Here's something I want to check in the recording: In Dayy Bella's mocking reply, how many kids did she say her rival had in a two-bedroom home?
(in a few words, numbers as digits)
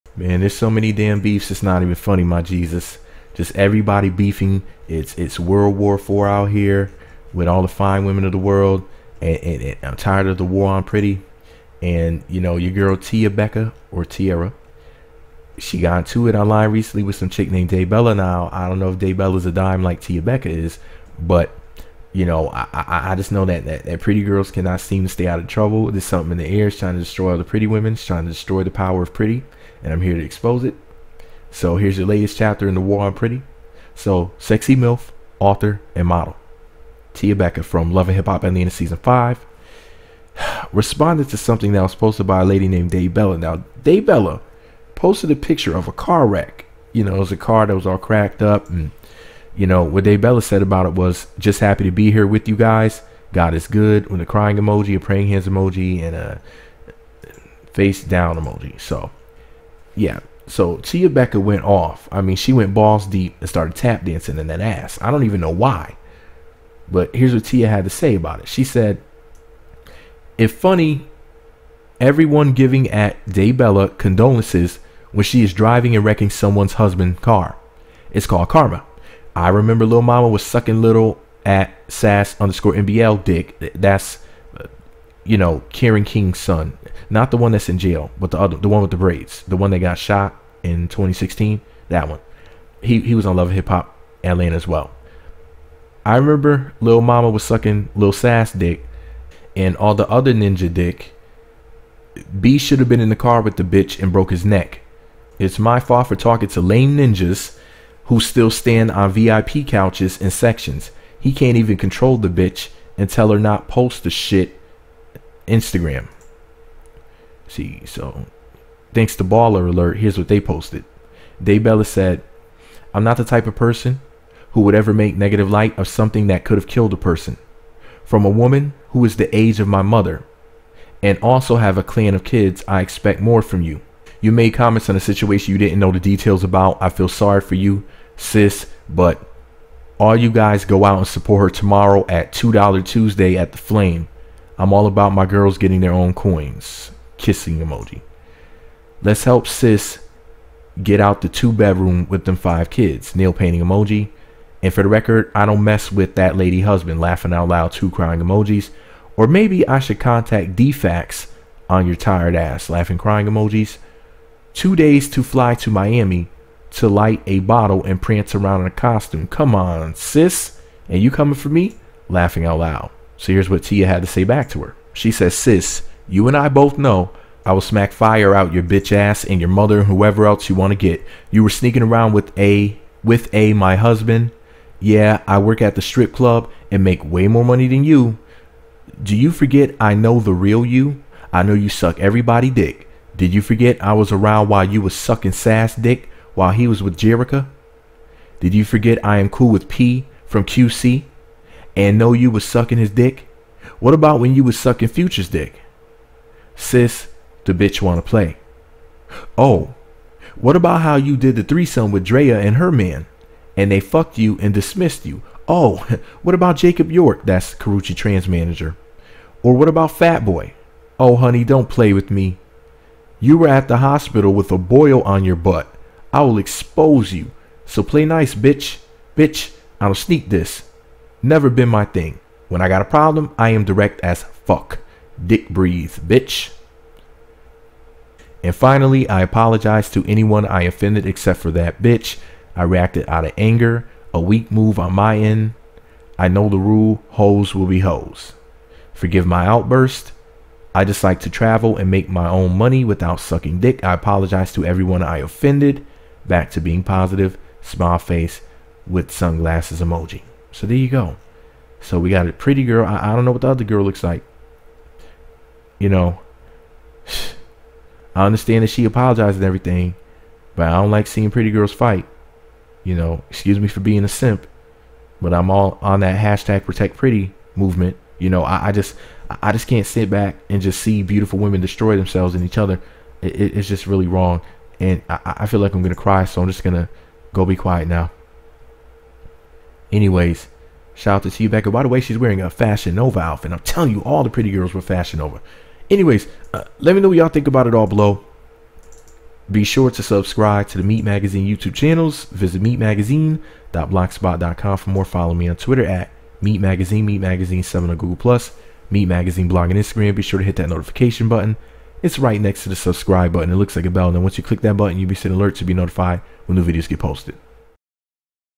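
5.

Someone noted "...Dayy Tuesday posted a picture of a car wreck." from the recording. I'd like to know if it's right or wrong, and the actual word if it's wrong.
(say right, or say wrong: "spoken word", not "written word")
wrong: "Bella", not "Tuesday".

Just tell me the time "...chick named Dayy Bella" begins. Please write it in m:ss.
0:17.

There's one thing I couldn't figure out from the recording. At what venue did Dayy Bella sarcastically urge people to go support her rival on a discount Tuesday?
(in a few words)
the Flame.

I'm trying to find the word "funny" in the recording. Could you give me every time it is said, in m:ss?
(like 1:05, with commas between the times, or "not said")
0:01, 1:10.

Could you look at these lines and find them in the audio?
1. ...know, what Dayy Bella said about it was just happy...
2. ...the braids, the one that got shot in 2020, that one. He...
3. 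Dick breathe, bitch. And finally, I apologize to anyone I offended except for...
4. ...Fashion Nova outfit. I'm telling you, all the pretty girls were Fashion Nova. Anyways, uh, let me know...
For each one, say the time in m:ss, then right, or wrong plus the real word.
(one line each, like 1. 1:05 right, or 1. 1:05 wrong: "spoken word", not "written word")
1. 0:49 right
2. 1:28 wrong: "2016", not "2020"
3. 3:55 right
4. 4:52 right.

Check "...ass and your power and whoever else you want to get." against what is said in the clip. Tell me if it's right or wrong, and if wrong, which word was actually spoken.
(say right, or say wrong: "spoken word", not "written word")
wrong: "mother", not "power".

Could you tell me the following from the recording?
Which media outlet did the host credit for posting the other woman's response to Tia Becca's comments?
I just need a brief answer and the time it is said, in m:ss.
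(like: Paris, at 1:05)
Baller Alert, at 1:59.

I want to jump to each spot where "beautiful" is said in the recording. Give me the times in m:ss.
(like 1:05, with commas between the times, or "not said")
4:41.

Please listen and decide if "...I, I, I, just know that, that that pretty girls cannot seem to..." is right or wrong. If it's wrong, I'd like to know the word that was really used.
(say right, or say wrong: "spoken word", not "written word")
right.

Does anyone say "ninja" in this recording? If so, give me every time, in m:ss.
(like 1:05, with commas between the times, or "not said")
1:40, 1:46.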